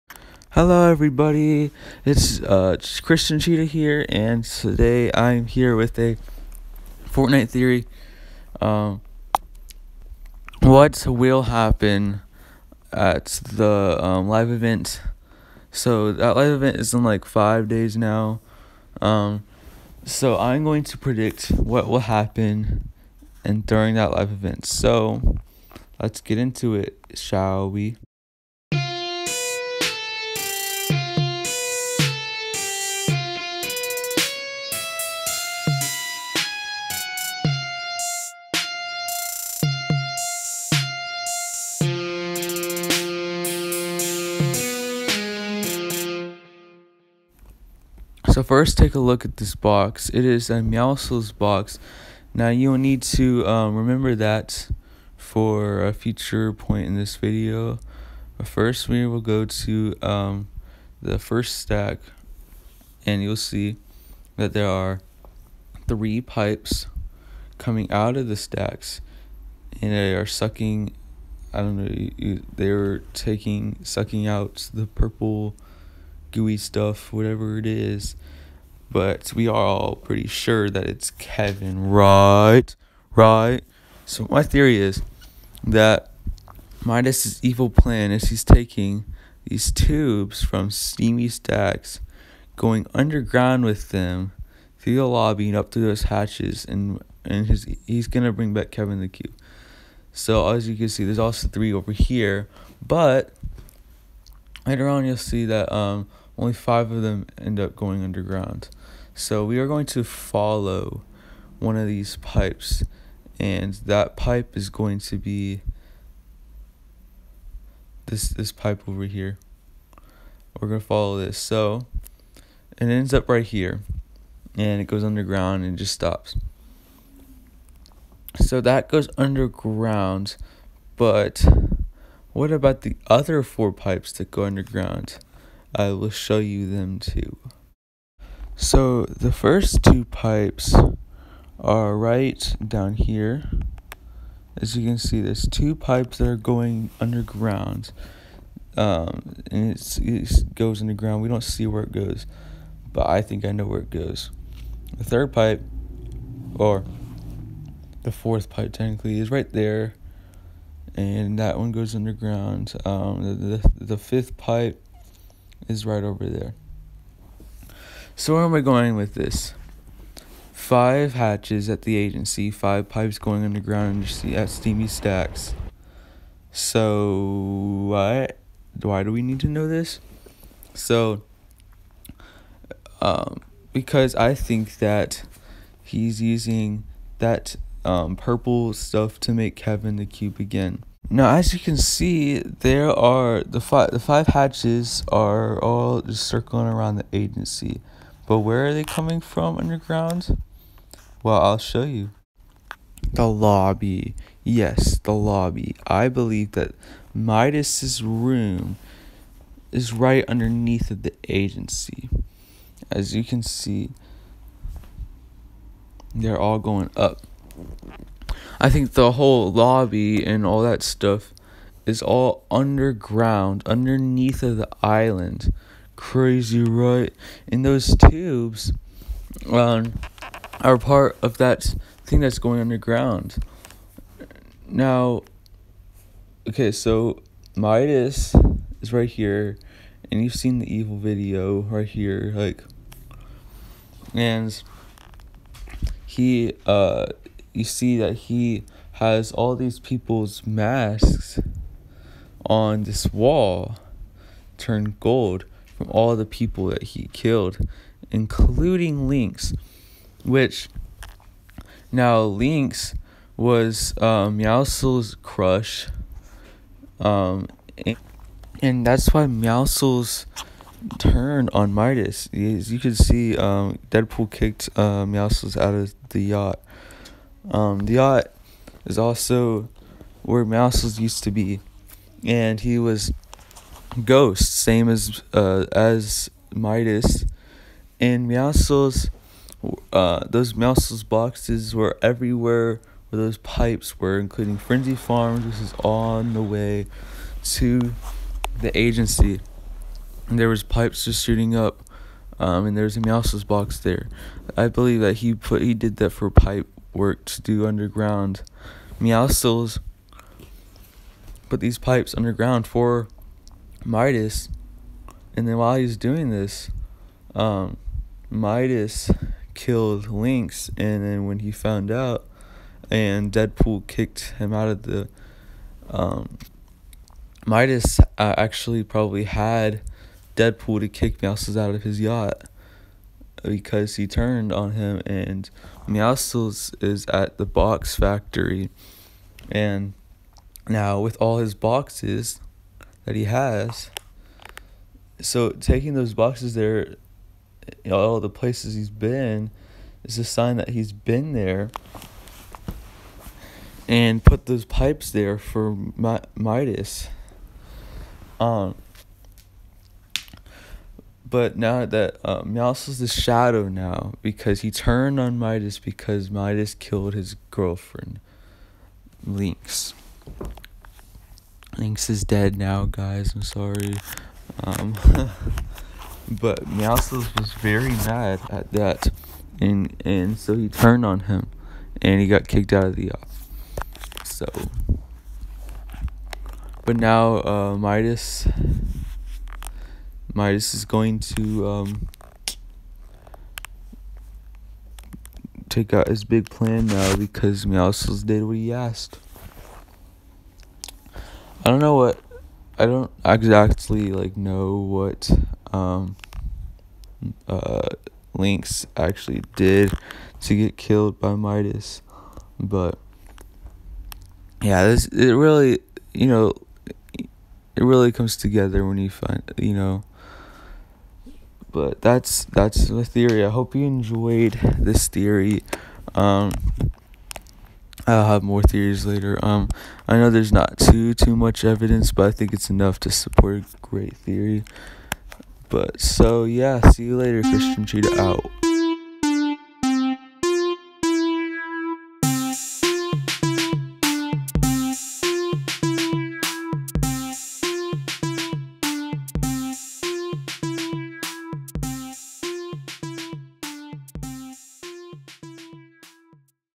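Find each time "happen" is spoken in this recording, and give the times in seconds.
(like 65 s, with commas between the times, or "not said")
11 s, 22 s.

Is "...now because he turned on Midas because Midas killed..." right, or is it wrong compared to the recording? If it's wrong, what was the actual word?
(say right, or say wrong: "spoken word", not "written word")
right.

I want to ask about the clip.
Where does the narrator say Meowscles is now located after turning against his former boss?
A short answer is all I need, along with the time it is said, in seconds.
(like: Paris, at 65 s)
the box factory, at 337 s.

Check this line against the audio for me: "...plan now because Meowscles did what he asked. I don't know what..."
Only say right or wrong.
right.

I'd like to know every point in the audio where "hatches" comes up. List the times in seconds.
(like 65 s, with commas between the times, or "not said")
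96 s, 171 s, 194 s.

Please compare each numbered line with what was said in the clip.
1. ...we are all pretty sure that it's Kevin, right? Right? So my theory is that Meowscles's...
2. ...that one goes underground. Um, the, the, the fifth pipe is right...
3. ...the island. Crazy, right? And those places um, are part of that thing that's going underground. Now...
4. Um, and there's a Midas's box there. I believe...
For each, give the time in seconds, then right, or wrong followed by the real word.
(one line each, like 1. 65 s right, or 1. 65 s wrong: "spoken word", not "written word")
1. 79 s wrong: "Midas", not "Meowscles"
2. 161 s right
3. 224 s wrong: "tubes", not "places"
4. 302 s wrong: "Mouse", not "Midas".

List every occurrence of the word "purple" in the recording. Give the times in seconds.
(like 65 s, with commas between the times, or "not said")
74 s, 188 s.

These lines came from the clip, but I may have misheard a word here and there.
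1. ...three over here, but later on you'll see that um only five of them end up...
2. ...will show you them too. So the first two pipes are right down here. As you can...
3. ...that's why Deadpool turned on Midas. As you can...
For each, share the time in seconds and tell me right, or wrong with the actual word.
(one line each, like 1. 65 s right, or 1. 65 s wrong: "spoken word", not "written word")
1. 101 s right
2. 135 s right
3. 268 s wrong: "Meowscles", not "Deadpool".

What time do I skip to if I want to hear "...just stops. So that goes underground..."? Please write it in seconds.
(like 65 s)
125 s.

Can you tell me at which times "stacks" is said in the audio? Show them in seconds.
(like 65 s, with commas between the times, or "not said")
61 s, 68 s, 91 s, 174 s.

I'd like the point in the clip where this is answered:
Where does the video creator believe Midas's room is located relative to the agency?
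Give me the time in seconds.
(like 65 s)
209 s.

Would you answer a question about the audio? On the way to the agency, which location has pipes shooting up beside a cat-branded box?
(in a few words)
Frenzy Farms.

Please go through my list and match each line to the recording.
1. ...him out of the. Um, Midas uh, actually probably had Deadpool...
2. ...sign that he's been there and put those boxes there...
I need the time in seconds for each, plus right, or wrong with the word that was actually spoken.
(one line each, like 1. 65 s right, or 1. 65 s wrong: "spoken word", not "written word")
1. 324 s right
2. 350 s wrong: "pipes", not "boxes".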